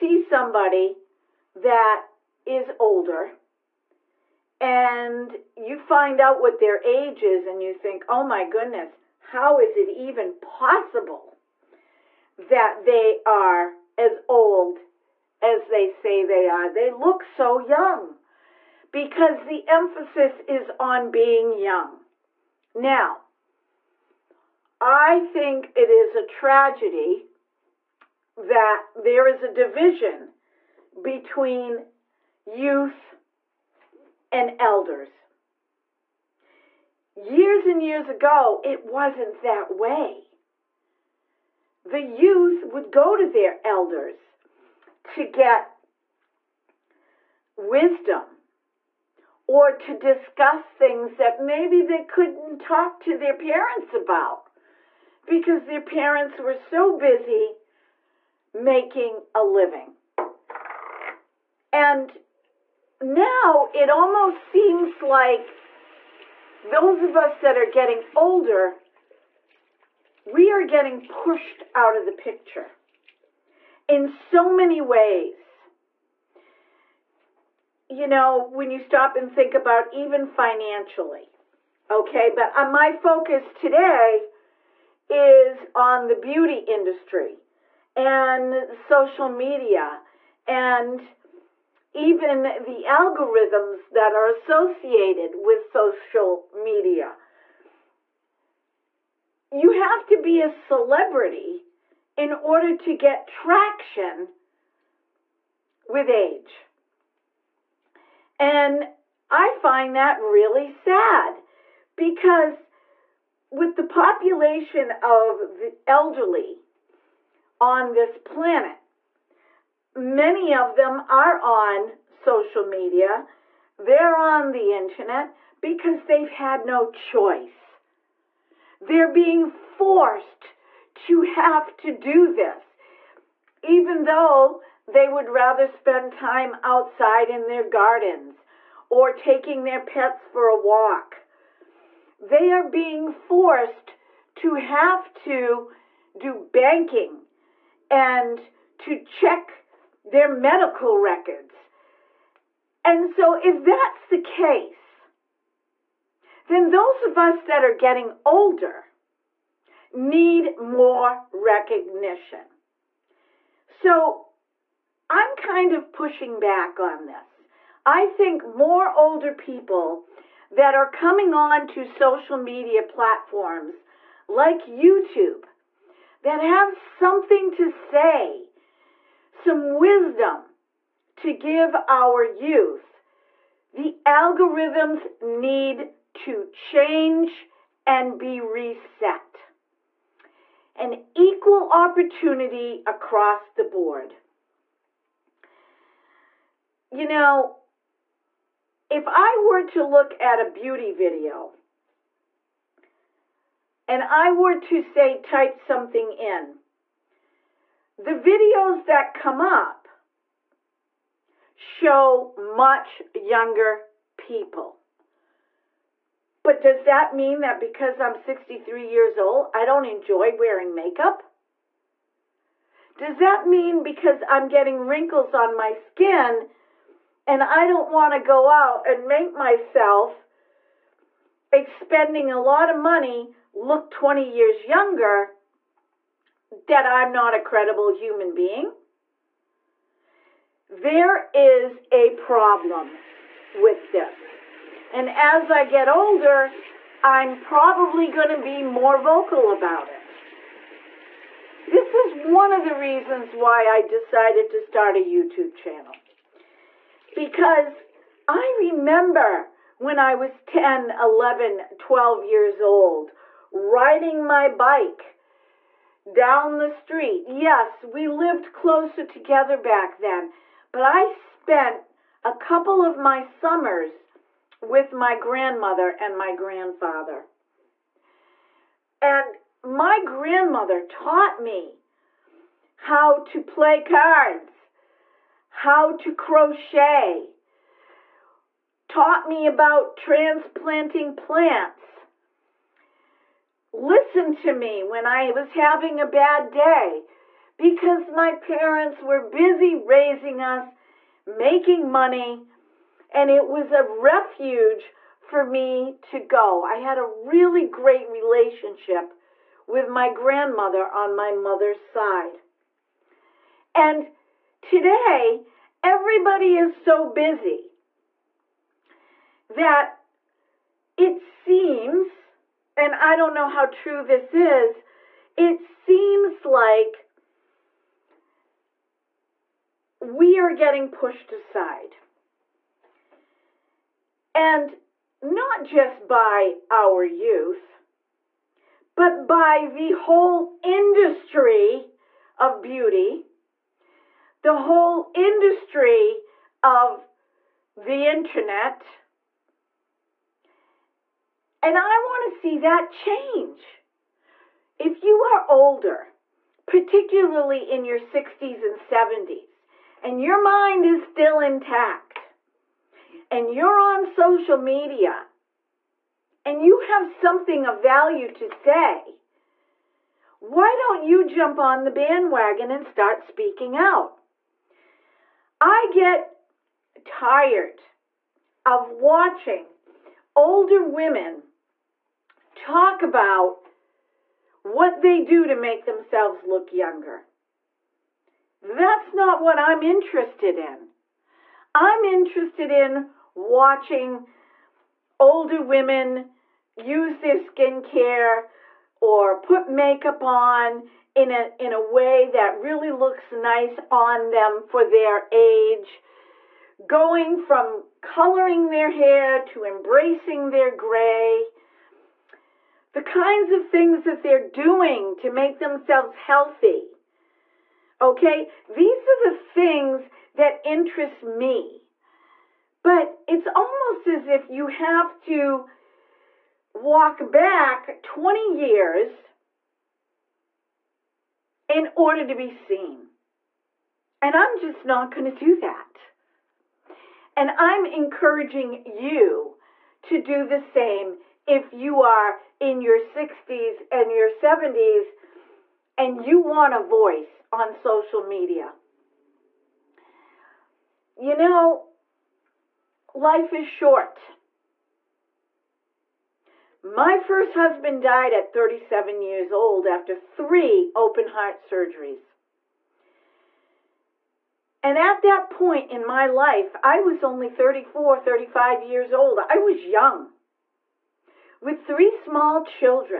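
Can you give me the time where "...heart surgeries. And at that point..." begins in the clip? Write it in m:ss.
7:41.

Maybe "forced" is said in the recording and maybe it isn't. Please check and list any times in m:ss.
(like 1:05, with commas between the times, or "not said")
2:09, 2:23.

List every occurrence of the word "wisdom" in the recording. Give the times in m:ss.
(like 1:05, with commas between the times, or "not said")
0:47, 2:59.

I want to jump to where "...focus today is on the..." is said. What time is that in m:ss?
1:22.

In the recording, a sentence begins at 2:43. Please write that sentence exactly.
So, I'm kind of pushing back on this.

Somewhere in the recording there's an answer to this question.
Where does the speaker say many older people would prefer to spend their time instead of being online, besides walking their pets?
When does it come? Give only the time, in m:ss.
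2:17.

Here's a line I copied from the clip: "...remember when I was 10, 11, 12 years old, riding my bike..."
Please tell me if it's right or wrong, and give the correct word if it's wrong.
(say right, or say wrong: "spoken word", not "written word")
right.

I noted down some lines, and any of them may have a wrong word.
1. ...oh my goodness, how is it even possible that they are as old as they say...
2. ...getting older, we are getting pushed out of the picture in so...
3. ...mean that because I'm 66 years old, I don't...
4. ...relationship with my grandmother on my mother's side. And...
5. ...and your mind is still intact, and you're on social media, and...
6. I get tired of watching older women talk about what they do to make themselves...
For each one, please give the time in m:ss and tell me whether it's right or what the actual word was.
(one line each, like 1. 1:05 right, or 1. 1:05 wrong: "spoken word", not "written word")
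1. 0:08 right
2. 1:07 right
3. 3:37 wrong: "63", not "66"
4. 5:08 right
5. 6:00 right
6. 6:15 right.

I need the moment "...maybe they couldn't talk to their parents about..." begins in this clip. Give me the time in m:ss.
0:51.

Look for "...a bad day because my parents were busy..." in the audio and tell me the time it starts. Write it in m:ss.
4:55.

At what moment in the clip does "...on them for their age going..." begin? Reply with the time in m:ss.
6:43.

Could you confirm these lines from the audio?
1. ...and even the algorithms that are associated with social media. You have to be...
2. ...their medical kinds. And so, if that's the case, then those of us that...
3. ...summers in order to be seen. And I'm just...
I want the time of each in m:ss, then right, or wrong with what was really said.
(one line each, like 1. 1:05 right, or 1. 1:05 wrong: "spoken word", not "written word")
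1. 1:30 right
2. 2:30 wrong: "records", not "kinds"
3. 7:08 wrong: "years", not "summers".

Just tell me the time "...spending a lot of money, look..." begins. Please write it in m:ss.
3:51.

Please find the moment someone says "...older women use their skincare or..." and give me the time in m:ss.
6:35.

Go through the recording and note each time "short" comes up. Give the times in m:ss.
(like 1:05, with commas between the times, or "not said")
7:33.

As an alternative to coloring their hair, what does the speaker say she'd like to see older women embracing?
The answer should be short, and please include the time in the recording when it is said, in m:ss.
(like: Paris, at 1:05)
their gray, at 6:50.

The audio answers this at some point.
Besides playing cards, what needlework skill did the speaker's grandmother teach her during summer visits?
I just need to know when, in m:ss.
4:46.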